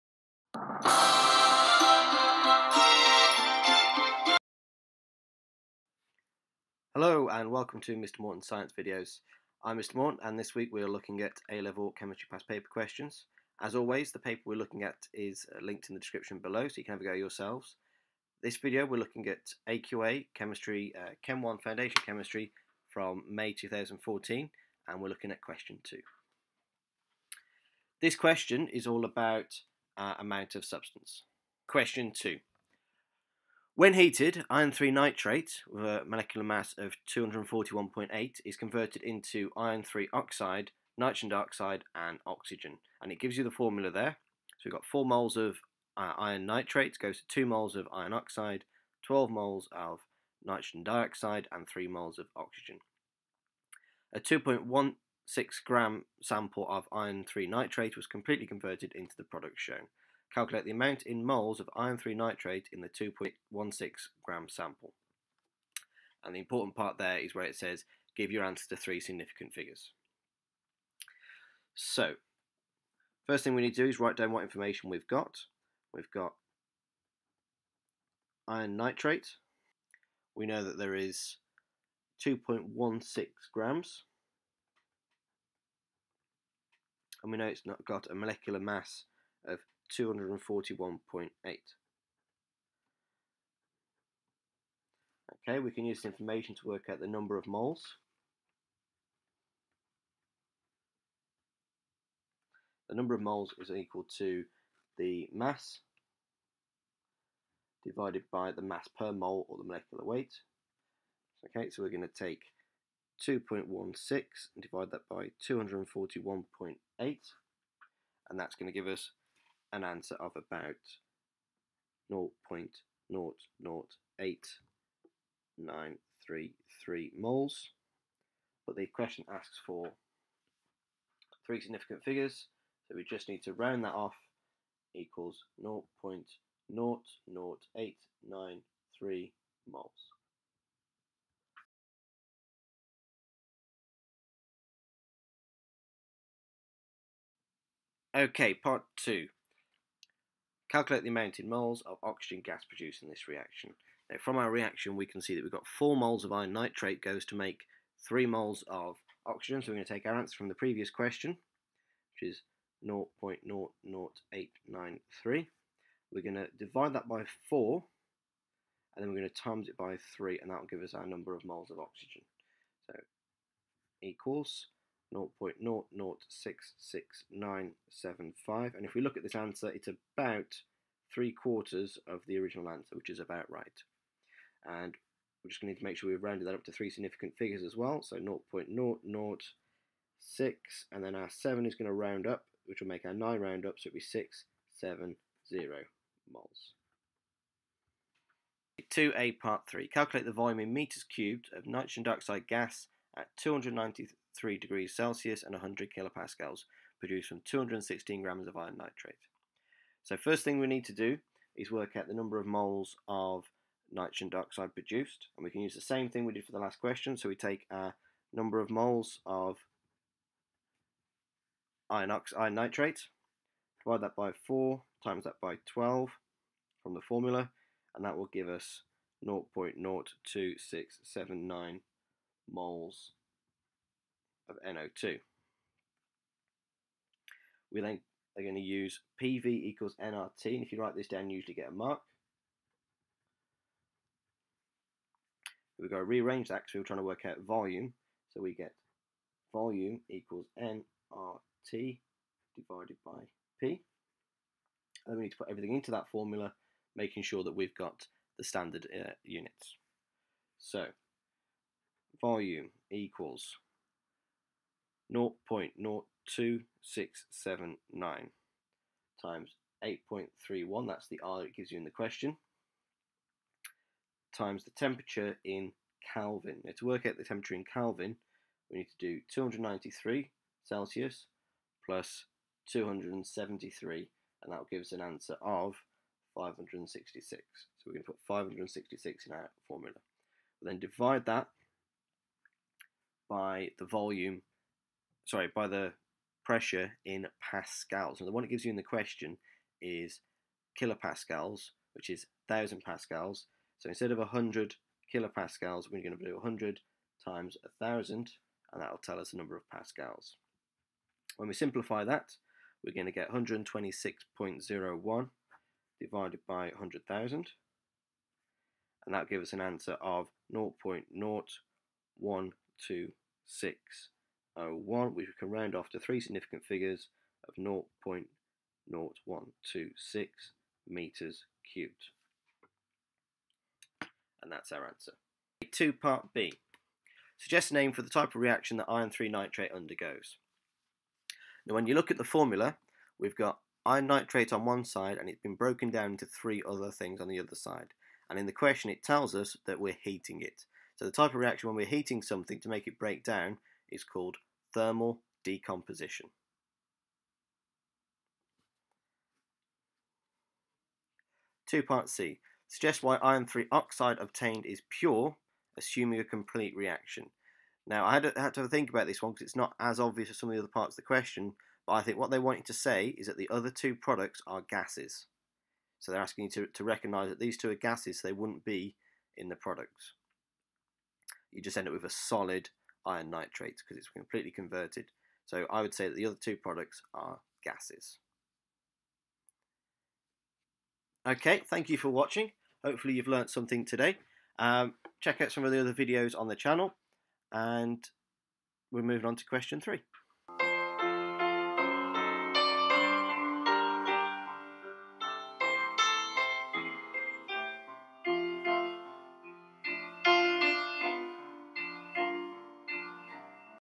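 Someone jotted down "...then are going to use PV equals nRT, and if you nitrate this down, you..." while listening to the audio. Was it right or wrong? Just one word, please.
wrong.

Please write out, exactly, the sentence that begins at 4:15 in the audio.
And then we need to put everything into that formula, making sure that we've got the standard uh, units.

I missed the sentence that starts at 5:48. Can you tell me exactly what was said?
And in the question it tells us that we're heating it.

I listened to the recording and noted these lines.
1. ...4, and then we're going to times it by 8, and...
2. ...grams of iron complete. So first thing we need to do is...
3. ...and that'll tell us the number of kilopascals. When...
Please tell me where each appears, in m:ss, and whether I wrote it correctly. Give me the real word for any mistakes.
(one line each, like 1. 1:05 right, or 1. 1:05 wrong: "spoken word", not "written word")
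1. 2:47 wrong: "3", not "8"
2. 3:28 wrong: "nitrate", not "complete"
3. 5:08 wrong: "pascals", not "kilopascals".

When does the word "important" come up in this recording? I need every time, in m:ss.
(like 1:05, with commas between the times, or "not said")
1:06.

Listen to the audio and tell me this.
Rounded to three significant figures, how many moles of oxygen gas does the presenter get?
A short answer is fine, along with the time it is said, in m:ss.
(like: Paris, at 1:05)
0.00670 moles, at 3:14.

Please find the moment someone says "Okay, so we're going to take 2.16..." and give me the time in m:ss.
1:51.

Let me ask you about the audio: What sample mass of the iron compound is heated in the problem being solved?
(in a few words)
2.16 grams.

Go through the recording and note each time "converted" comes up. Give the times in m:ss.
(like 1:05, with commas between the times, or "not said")
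0:38, 0:58, 6:24.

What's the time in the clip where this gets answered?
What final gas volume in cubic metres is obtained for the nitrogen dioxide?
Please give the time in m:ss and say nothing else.
5:27.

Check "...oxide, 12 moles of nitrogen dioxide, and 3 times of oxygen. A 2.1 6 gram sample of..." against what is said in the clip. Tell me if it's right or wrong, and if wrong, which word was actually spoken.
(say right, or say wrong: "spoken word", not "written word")
wrong: "moles", not "times".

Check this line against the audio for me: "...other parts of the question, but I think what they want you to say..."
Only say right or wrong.
right.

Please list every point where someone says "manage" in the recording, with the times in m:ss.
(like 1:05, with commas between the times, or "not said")
not said.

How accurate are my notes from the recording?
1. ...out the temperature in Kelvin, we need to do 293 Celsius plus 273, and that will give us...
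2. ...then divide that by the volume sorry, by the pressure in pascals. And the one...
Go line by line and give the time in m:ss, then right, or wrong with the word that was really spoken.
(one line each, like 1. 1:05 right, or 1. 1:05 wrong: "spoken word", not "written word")
1. 4:37 right
2. 4:50 right.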